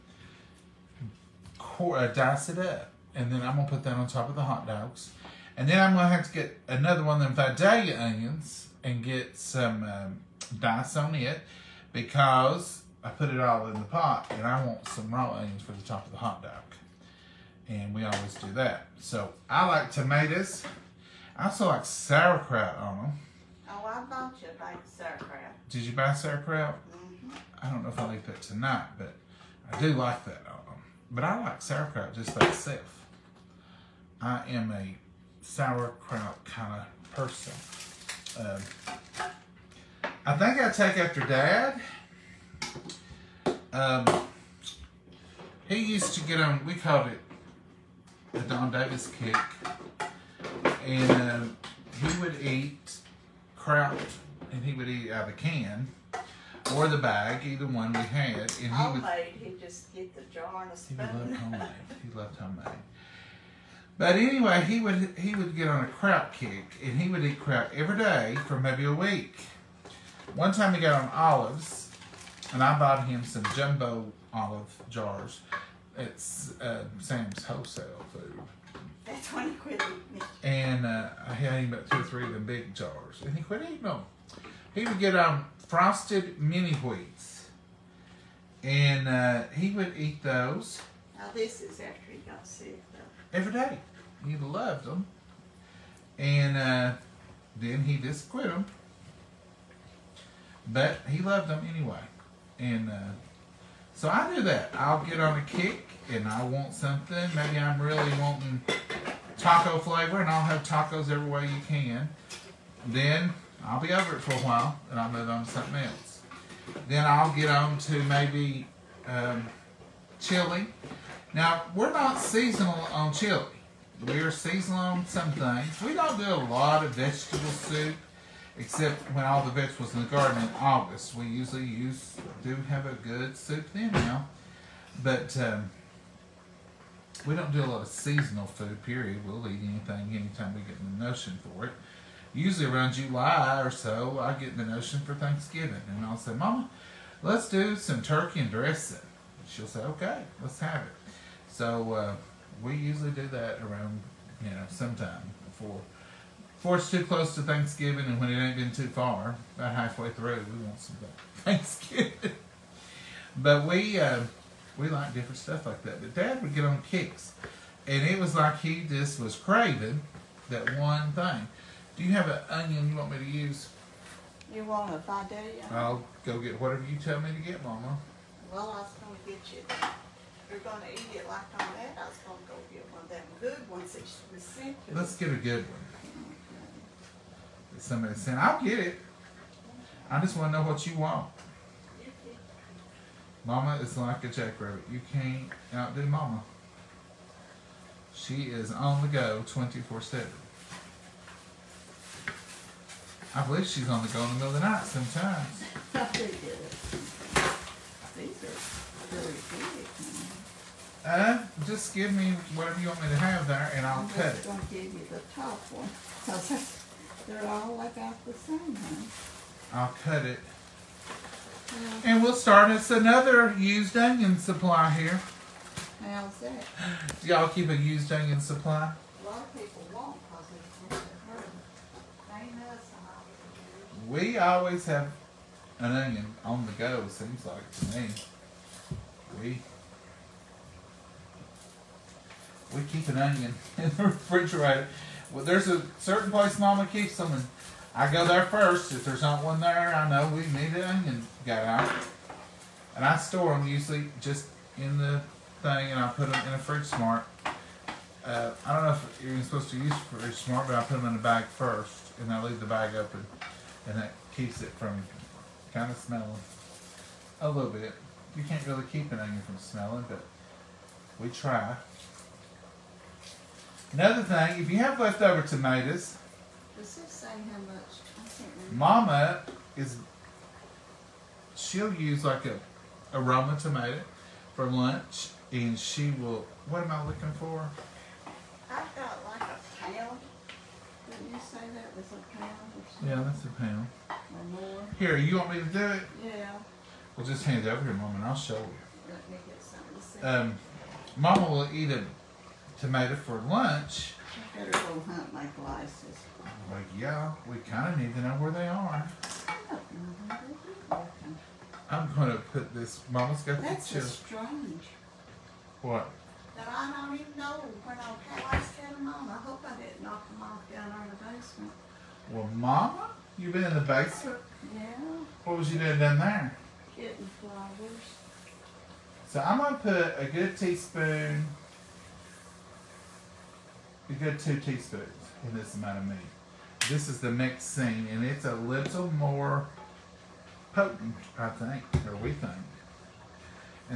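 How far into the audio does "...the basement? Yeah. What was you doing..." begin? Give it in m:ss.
5:23.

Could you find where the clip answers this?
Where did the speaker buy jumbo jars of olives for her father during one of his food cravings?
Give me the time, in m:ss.
1:16.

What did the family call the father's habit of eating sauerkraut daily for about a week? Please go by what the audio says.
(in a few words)
the Don Davis kick.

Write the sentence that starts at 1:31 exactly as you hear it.
Now this is after he got sick, though.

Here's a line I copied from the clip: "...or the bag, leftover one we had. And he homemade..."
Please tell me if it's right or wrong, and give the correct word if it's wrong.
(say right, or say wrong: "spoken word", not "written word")
wrong: "either", not "leftover".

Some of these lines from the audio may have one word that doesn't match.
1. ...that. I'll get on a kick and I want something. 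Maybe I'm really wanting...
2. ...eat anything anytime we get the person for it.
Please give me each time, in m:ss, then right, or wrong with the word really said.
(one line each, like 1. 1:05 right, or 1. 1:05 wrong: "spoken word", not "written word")
1. 1:44 right
2. 2:19 wrong: "notion", not "person".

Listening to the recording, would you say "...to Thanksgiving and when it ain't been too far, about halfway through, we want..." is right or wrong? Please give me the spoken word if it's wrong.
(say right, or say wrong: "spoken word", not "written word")
right.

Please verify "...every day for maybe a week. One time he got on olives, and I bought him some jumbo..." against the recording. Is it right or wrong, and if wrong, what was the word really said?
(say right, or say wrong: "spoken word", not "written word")
right.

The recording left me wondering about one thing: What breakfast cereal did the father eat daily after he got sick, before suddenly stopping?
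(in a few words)
Frosted Mini Wheats.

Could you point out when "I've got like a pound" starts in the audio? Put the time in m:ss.
4:48.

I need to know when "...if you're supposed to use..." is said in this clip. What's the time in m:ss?
4:18.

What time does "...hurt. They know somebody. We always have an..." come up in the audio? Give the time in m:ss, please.
3:51.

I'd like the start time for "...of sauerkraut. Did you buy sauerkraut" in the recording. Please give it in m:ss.
0:24.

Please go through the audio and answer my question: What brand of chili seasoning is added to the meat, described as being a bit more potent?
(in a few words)
Mexene.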